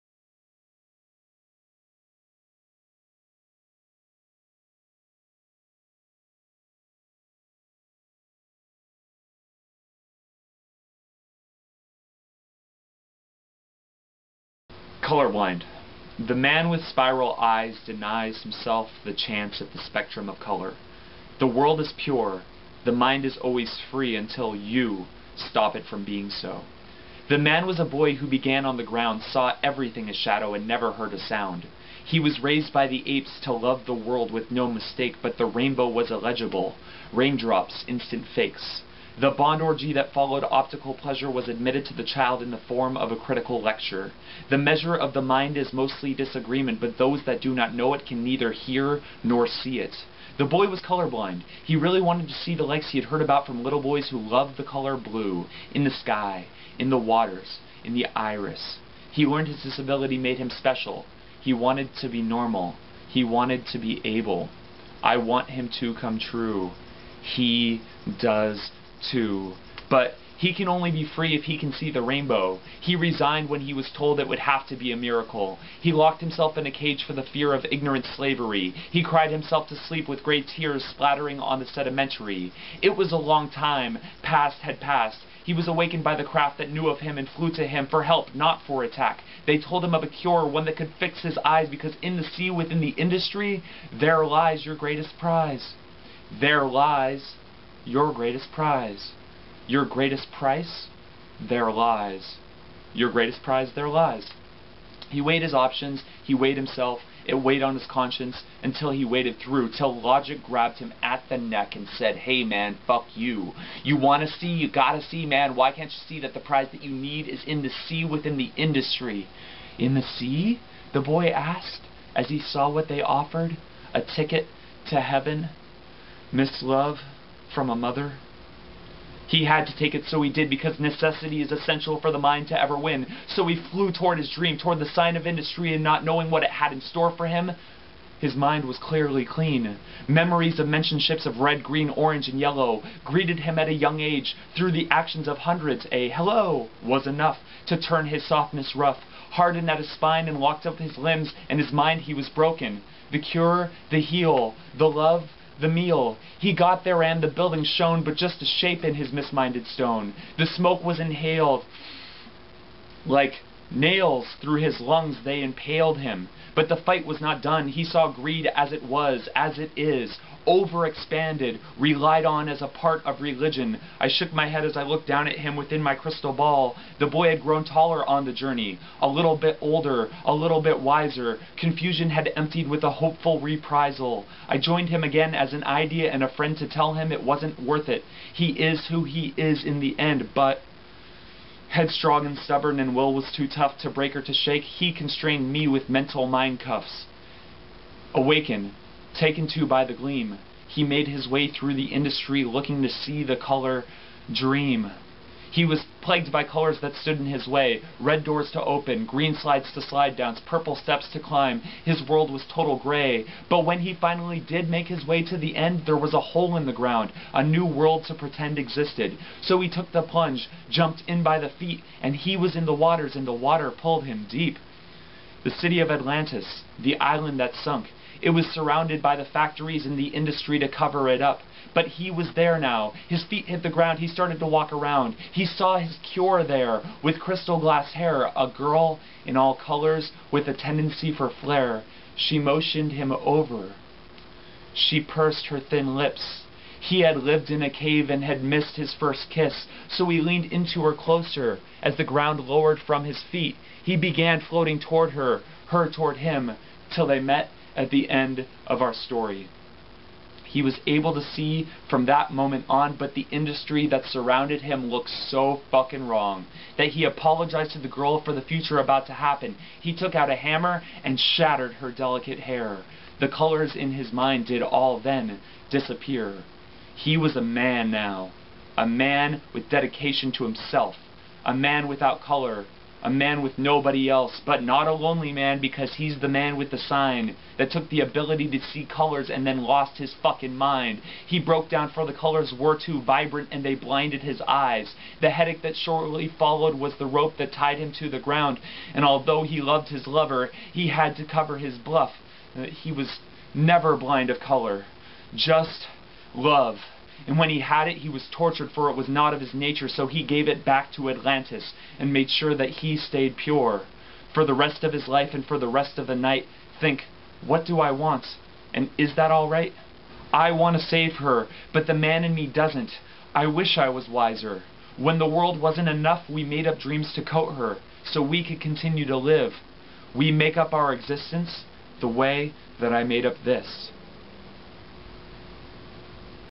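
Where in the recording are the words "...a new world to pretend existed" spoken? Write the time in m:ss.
3:37.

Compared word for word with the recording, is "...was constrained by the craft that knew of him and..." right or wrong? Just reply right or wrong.
wrong.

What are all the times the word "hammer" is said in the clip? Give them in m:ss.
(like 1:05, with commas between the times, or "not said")
4:30.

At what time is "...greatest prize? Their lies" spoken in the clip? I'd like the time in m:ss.
1:43.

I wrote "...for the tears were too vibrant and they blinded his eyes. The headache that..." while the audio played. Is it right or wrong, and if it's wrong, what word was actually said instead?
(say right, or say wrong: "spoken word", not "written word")
wrong: "colors", not "tears".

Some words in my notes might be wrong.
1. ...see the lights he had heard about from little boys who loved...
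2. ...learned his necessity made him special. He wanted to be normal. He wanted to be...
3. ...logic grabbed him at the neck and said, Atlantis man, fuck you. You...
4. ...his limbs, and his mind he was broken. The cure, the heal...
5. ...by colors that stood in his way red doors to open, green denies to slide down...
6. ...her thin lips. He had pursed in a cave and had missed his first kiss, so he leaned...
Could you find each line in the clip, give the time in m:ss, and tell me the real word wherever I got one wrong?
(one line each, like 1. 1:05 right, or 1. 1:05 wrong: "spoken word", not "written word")
1. 0:52 right
2. 0:59 wrong: "disability", not "necessity"
3. 1:49 wrong: "Hey", not "Atlantis"
4. 2:30 right
5. 3:26 wrong: "slides", not "denies"
6. 4:05 wrong: "lived", not "pursed".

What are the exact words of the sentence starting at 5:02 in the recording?
Uh, he was never blind of color, just love.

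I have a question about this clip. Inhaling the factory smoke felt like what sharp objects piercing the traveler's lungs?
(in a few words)
Nails.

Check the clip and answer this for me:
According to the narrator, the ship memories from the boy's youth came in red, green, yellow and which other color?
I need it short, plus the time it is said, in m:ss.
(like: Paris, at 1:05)
Orange, at 2:21.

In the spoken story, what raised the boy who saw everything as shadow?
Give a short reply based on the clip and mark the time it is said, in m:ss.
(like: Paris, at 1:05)
The apes, at 0:32.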